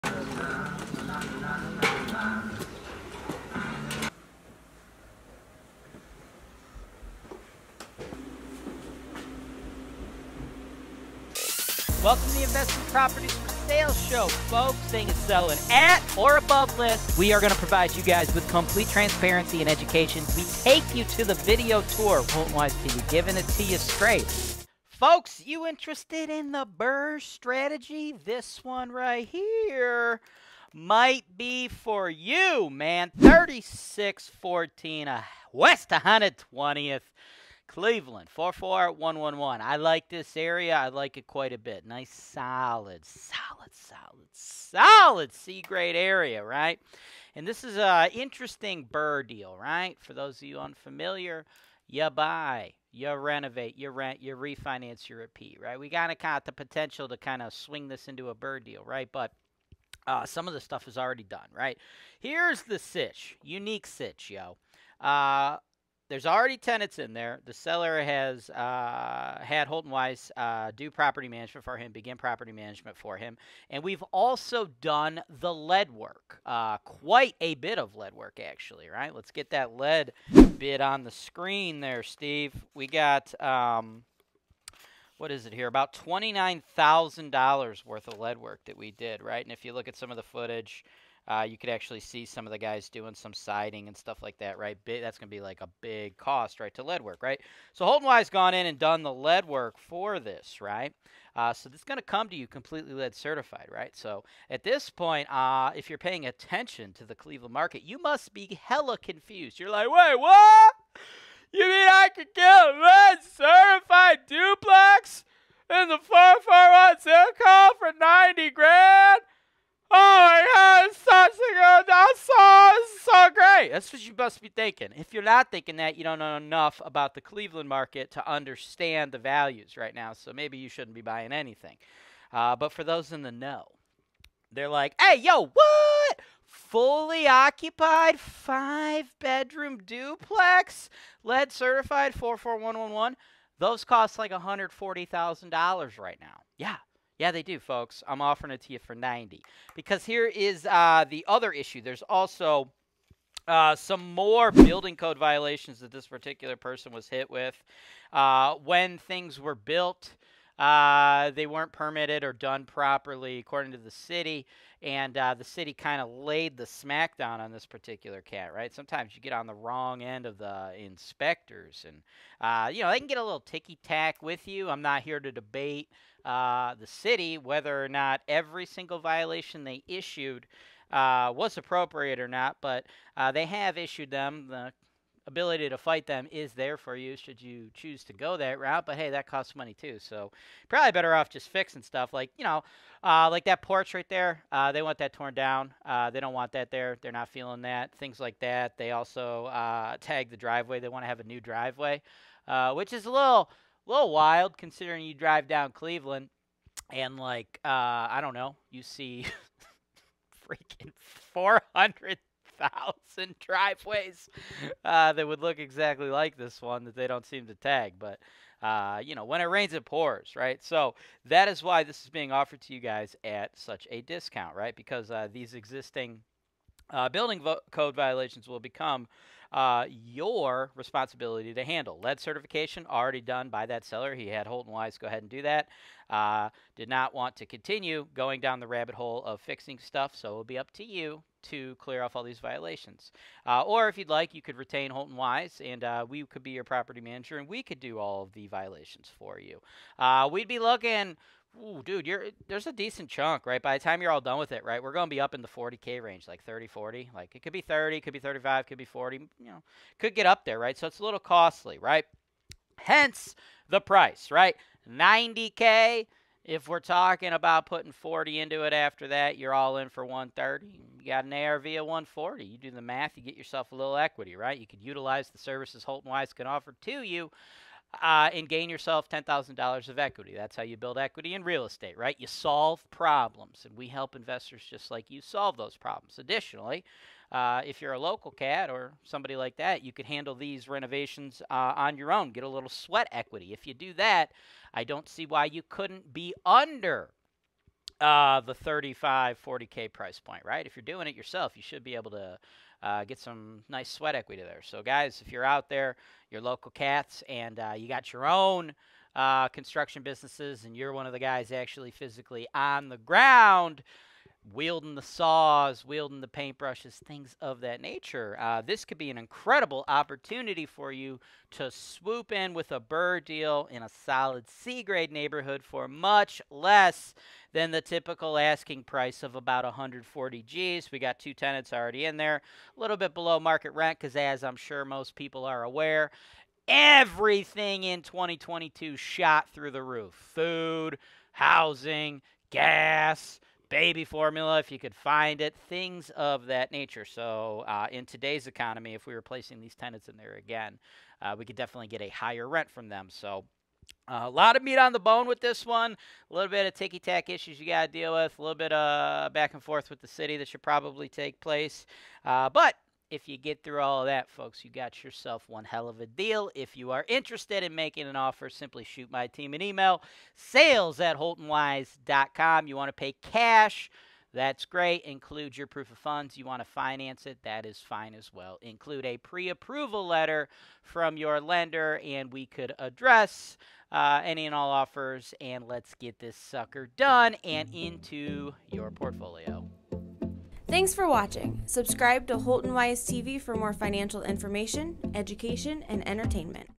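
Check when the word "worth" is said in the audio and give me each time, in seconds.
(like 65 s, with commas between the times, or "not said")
87 s.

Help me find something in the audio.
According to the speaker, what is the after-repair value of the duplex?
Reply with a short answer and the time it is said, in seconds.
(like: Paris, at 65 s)
140, at 271 s.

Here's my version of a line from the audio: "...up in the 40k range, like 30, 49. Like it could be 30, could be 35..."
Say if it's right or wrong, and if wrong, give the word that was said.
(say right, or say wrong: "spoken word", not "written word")
wrong: "40", not "49".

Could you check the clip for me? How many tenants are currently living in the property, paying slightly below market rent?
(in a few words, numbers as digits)
2.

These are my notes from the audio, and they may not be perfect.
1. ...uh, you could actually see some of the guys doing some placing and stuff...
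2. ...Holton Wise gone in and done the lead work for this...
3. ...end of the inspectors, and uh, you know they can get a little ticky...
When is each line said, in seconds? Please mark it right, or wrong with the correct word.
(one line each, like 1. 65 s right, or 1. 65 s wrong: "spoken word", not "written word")
1. 91 s wrong: "siding", not "placing"
2. 97 s right
3. 170 s right.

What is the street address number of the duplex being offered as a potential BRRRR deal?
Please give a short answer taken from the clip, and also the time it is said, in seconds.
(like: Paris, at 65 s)
3614, at 33 s.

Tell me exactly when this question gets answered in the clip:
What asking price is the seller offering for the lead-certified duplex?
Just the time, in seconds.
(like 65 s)
148 s.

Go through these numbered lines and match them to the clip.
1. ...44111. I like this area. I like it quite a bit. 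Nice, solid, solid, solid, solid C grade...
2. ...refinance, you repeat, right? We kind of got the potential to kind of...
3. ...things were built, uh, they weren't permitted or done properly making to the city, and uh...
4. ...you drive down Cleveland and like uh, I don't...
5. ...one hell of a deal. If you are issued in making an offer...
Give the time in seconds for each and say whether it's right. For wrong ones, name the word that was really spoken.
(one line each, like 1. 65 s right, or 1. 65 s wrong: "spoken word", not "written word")
1. 38 s right
2. 54 s right
3. 158 s wrong: "according", not "making"
4. 205 s right
5. 365 s wrong: "interested", not "issued".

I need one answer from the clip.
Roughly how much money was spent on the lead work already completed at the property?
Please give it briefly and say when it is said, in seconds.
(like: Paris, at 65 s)
$29,000, at 85 s.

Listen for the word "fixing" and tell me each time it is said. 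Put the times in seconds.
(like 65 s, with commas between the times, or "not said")
191 s, 239 s.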